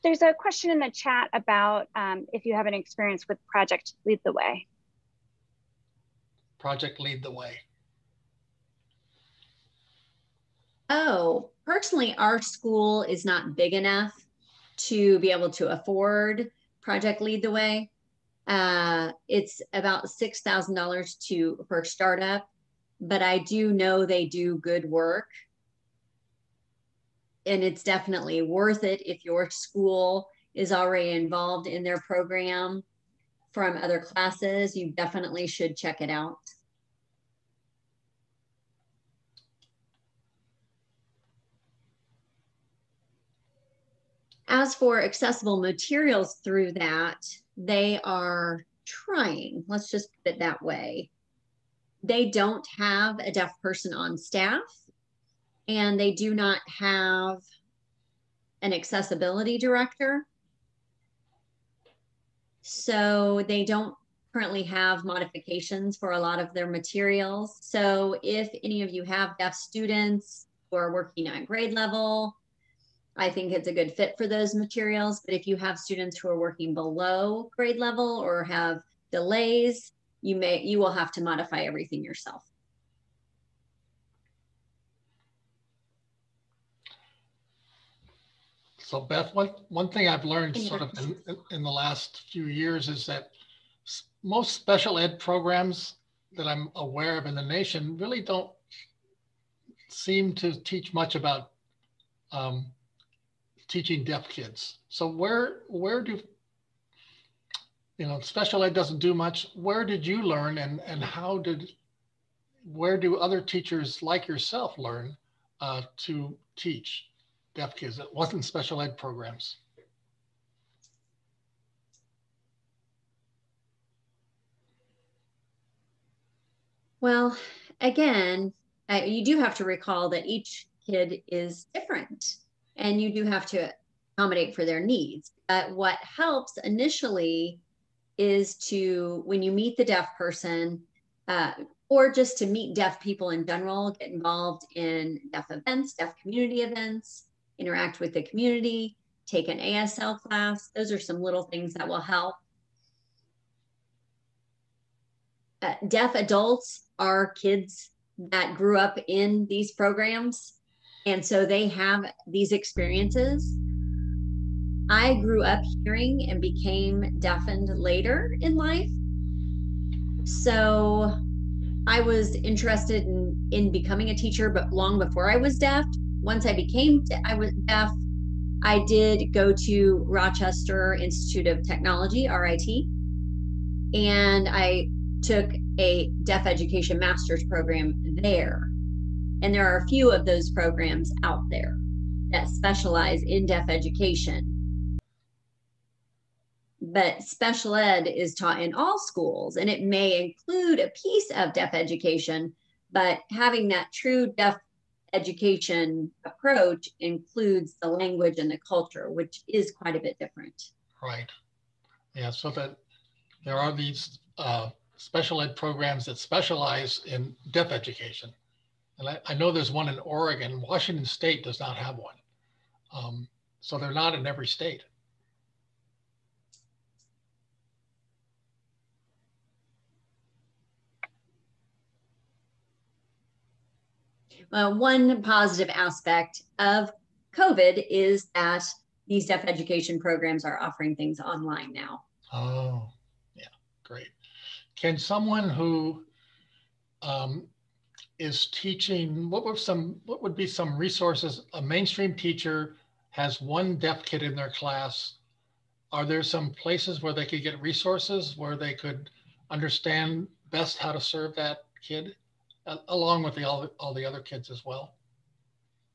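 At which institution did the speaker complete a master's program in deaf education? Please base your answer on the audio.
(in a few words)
Rochester Institute of Technology.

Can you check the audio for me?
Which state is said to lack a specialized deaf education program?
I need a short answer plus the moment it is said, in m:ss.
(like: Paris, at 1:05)
Washington State, at 3:40.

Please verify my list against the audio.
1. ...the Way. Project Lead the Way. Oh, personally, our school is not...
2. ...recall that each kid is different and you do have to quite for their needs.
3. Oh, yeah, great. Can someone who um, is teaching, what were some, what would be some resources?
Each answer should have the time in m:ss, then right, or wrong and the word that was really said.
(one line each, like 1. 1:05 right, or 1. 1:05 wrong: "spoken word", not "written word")
1. 0:04 right
2. 2:09 wrong: "accommodate", not "quite"
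3. 4:02 right.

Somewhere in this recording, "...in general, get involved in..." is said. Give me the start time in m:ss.
2:23.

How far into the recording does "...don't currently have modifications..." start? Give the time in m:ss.
1:03.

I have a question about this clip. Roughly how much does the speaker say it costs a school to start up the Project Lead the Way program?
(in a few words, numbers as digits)
$6,000.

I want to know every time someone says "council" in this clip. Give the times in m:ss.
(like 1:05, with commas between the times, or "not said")
not said.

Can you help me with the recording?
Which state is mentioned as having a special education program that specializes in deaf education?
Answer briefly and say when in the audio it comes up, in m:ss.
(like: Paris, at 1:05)
Oregon, at 3:39.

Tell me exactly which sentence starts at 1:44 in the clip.
So where where do you know special ed doesn't do much?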